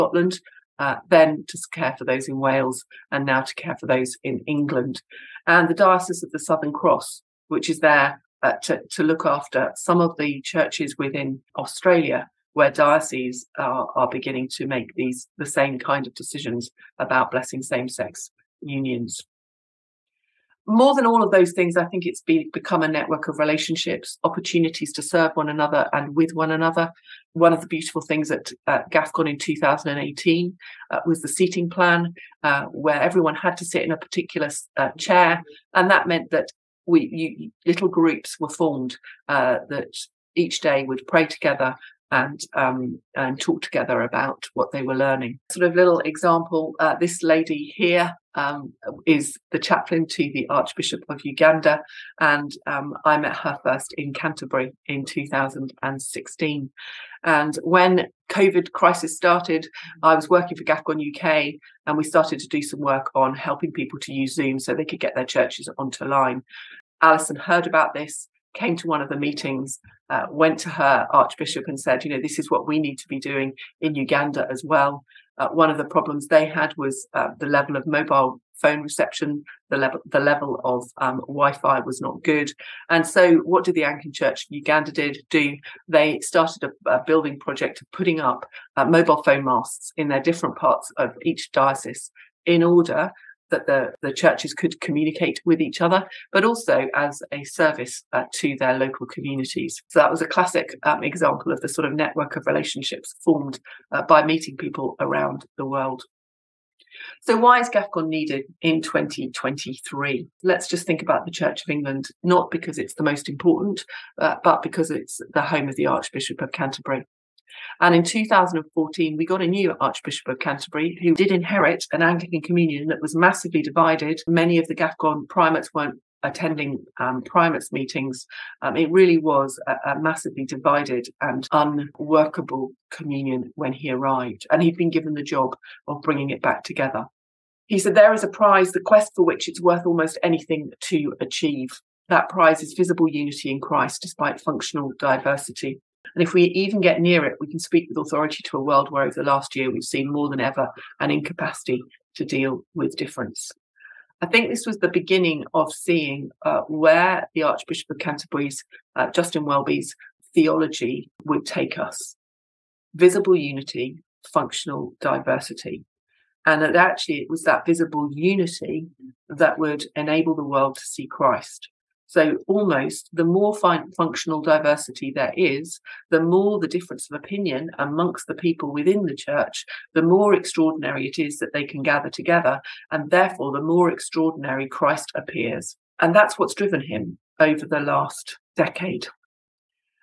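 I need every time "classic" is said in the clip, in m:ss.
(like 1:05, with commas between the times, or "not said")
1:40.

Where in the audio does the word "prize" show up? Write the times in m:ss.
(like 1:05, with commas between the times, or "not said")
2:18, 2:22.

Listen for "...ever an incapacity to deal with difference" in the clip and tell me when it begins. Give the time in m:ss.
2:30.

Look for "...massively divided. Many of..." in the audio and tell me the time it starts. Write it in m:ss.
2:03.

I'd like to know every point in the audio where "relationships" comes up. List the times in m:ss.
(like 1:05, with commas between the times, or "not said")
0:23, 1:42.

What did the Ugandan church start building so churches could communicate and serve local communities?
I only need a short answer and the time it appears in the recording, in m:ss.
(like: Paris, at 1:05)
mobile phone masts, at 1:28.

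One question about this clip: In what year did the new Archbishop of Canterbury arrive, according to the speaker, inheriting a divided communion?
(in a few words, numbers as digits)
2014.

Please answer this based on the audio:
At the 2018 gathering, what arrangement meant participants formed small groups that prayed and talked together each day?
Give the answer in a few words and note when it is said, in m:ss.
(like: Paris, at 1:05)
seating plan, at 0:31.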